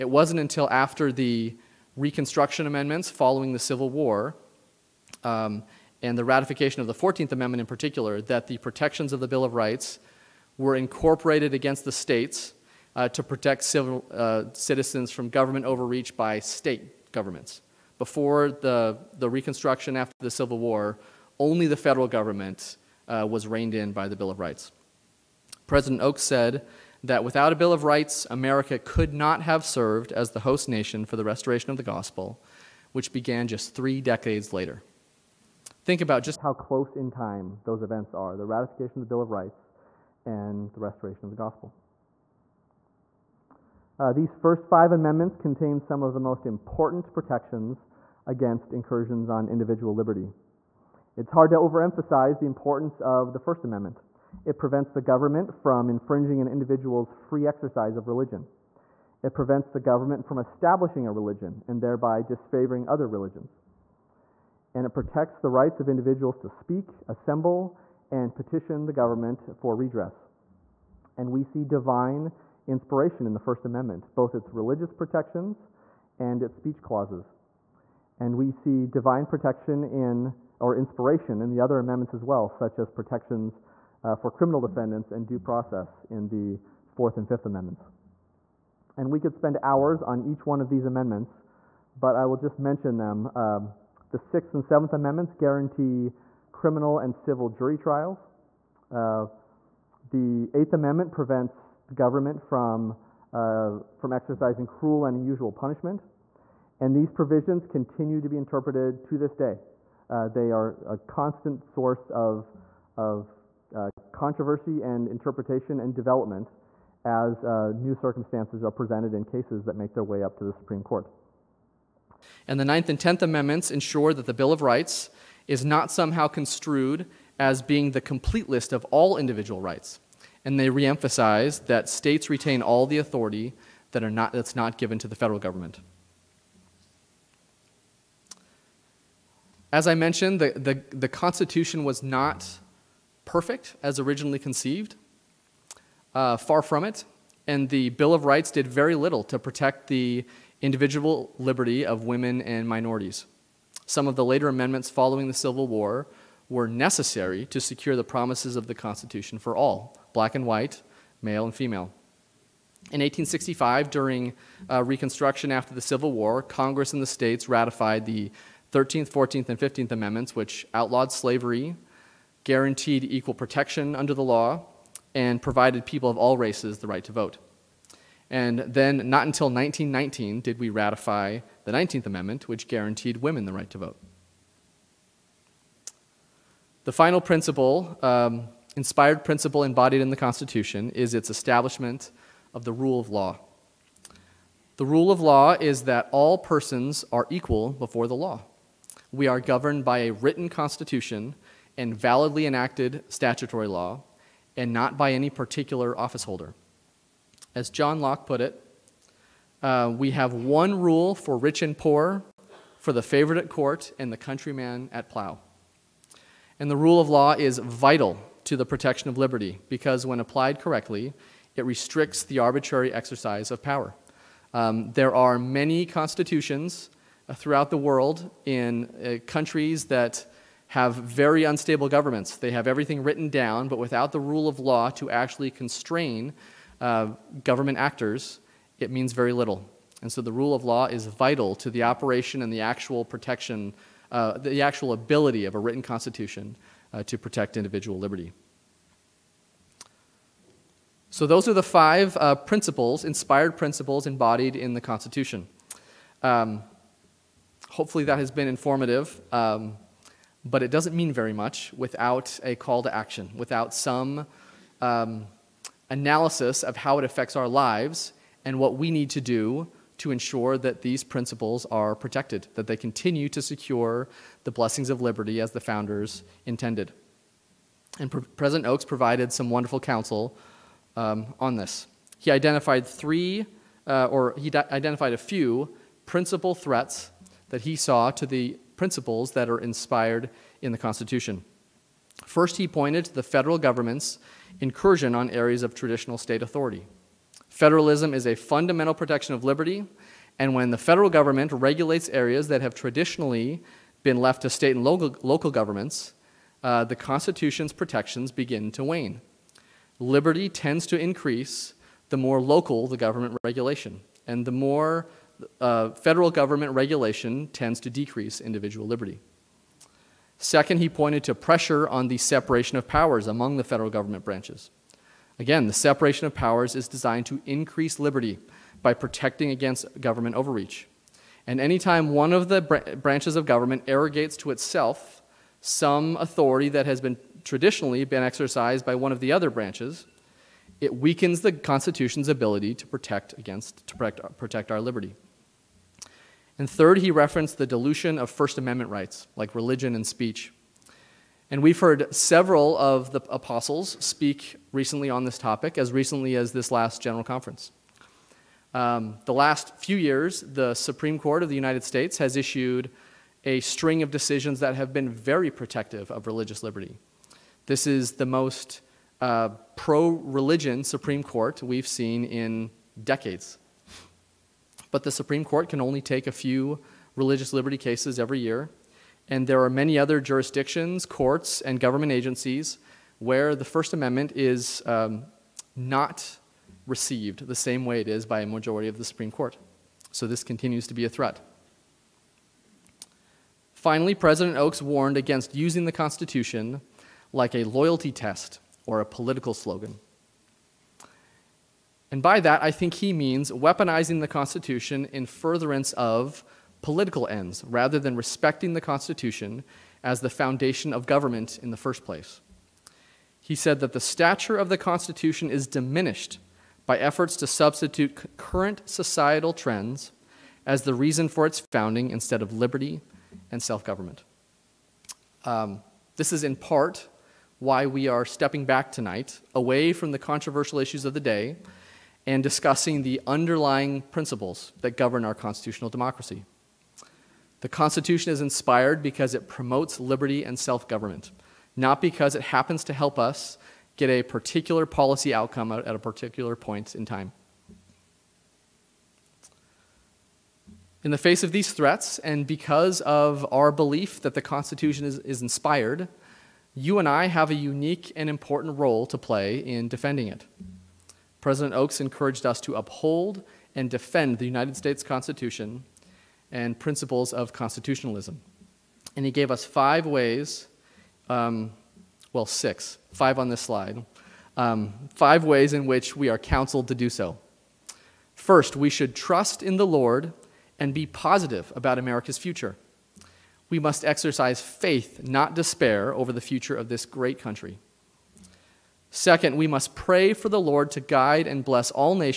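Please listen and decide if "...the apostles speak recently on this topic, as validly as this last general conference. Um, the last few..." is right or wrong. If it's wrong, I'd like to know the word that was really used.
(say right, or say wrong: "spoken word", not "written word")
wrong: "recently", not "validly".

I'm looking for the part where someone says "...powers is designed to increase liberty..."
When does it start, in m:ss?
5:26.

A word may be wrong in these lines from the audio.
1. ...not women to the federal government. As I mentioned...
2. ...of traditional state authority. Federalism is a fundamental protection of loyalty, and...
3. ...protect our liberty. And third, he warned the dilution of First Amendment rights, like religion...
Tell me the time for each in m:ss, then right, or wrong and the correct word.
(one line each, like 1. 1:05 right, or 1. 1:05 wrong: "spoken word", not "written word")
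1. 2:14 wrong: "given", not "women"
2. 4:55 wrong: "liberty", not "loyalty"
3. 5:44 wrong: "referenced", not "warned".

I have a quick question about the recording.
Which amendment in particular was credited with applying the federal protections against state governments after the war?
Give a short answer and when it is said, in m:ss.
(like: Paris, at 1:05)
14th Amendment, at 0:06.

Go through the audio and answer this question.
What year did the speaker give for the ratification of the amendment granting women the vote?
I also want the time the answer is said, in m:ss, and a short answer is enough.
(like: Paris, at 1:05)
1919, at 2:59.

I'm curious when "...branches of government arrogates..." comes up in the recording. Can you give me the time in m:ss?
5:32.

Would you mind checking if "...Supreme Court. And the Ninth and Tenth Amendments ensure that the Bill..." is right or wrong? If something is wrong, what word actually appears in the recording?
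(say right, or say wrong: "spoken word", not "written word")
right.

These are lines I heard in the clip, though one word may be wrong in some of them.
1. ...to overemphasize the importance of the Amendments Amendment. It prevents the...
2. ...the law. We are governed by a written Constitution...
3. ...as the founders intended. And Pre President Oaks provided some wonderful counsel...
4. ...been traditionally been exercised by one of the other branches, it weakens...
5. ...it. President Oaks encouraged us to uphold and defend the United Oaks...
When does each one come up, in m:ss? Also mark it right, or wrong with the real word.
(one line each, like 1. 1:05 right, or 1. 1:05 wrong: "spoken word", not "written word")
1. 0:51 wrong: "First", not "Amendments"
2. 3:18 right
3. 4:35 right
4. 5:37 right
5. 7:40 wrong: "States", not "Oaks".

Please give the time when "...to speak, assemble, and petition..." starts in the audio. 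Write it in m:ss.
1:06.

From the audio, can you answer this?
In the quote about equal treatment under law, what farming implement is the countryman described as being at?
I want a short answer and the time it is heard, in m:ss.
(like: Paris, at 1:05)
plow, at 3:35.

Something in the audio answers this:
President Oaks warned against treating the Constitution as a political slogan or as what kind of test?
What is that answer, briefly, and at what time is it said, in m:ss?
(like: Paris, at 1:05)
loyalty test, at 6:37.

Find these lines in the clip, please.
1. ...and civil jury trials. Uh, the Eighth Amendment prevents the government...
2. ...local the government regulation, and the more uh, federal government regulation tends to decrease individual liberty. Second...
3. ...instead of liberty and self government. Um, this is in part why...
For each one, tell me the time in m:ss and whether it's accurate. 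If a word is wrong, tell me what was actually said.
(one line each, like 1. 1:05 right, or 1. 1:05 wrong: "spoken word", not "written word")
1. 1:36 right
2. 5:12 right
3. 7:02 right.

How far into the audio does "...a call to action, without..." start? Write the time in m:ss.
4:22.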